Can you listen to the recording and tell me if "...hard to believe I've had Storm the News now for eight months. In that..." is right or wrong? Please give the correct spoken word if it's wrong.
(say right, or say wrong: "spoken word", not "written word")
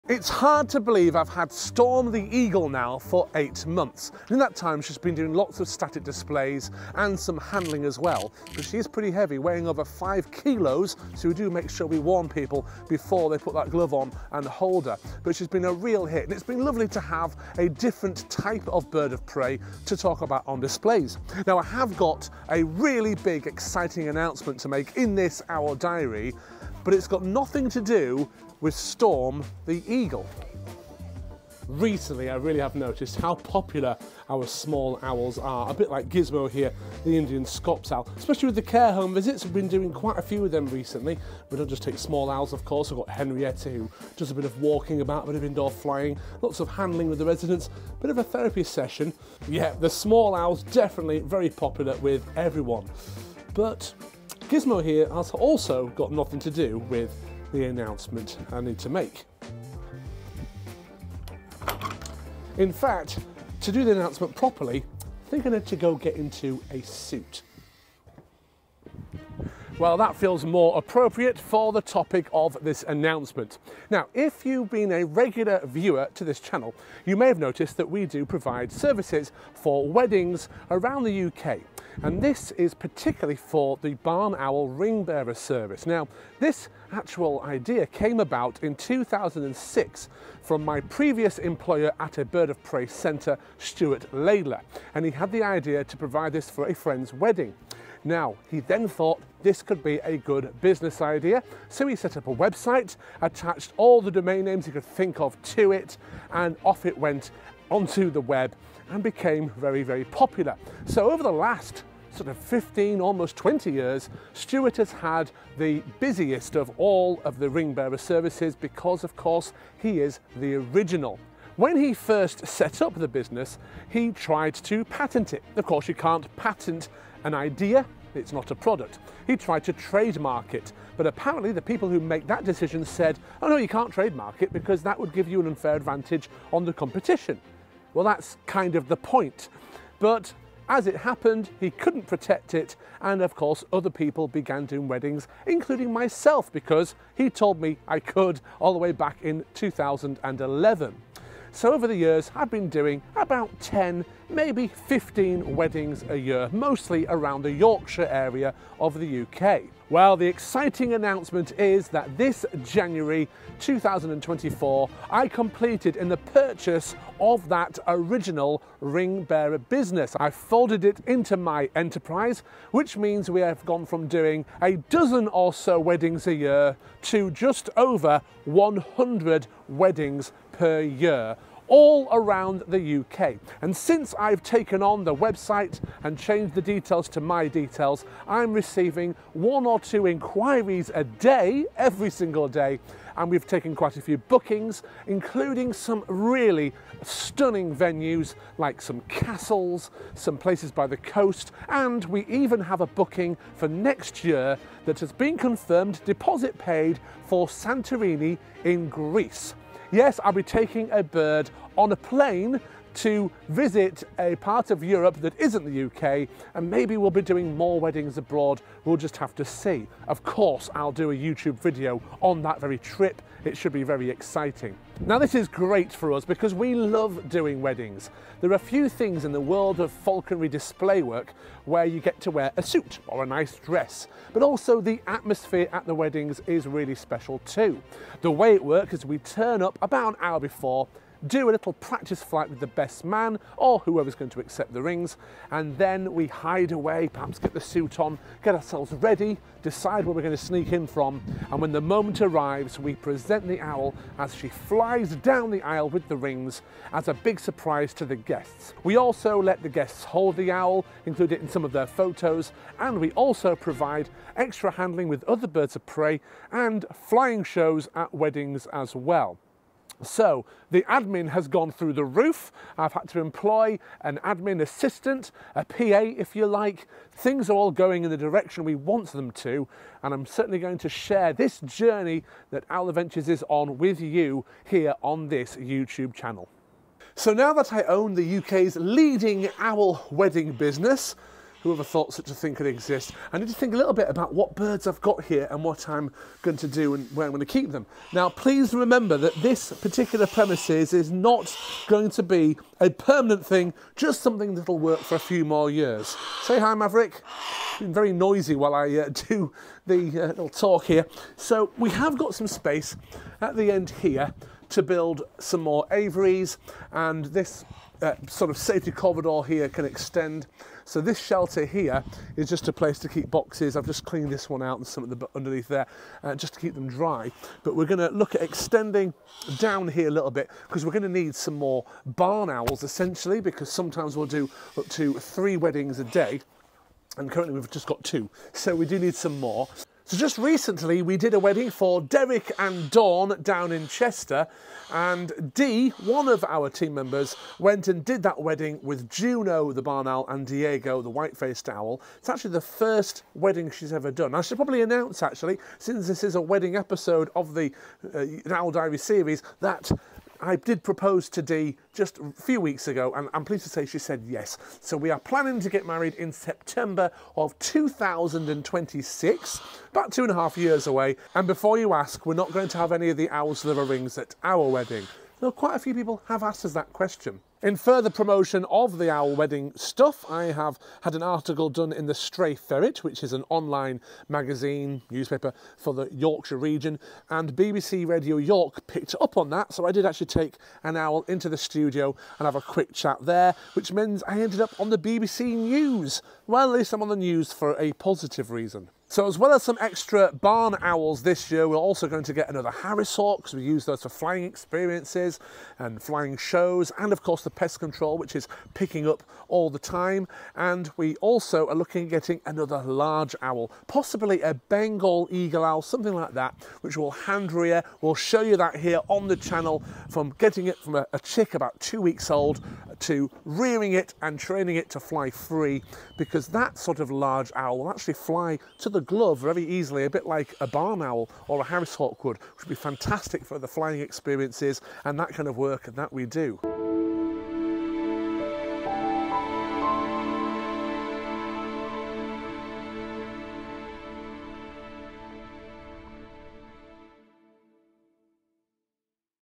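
wrong: "Eagle", not "News".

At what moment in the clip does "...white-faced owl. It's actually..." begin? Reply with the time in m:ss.
5:51.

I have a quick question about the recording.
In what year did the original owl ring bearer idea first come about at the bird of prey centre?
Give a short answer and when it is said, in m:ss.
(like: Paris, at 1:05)
2006, at 1:28.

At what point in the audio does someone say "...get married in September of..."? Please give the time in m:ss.
6:05.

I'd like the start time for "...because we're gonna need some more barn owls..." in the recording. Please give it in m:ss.
5:30.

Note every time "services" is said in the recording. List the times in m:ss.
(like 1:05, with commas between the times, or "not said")
1:18, 1:25, 1:57.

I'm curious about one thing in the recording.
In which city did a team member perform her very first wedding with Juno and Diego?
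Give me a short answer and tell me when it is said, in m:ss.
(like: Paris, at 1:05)
Chester, at 5:43.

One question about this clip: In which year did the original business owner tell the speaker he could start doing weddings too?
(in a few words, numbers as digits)
2011.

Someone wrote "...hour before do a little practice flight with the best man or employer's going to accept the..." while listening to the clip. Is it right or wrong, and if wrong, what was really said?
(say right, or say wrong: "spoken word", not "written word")
wrong: "whoever", not "employer".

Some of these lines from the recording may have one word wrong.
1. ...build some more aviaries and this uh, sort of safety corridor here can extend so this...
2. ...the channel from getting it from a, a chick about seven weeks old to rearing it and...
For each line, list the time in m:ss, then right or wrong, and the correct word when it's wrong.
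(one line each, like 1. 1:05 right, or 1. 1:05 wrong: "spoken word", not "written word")
1. 5:14 right
2. 6:59 wrong: "two", not "seven".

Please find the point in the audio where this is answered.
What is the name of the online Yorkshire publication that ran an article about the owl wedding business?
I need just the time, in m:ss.
6:22.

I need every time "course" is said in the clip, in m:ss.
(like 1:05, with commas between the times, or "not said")
0:42, 1:59, 2:05, 2:23, 3:40, 6:47.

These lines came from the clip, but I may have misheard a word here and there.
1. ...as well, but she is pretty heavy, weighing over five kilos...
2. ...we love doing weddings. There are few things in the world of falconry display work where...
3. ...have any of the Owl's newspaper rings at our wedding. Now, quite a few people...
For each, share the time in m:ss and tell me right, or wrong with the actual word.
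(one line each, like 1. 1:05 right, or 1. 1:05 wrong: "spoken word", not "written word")
1. 0:07 right
2. 3:46 right
3. 6:12 wrong: "liver", not "newspaper".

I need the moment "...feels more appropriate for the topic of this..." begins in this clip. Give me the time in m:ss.
1:10.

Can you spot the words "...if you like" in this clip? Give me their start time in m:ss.
4:35.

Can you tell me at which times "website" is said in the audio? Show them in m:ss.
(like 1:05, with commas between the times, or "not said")
1:42, 3:05.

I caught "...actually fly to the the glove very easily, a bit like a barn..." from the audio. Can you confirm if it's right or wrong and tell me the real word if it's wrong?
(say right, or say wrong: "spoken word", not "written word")
right.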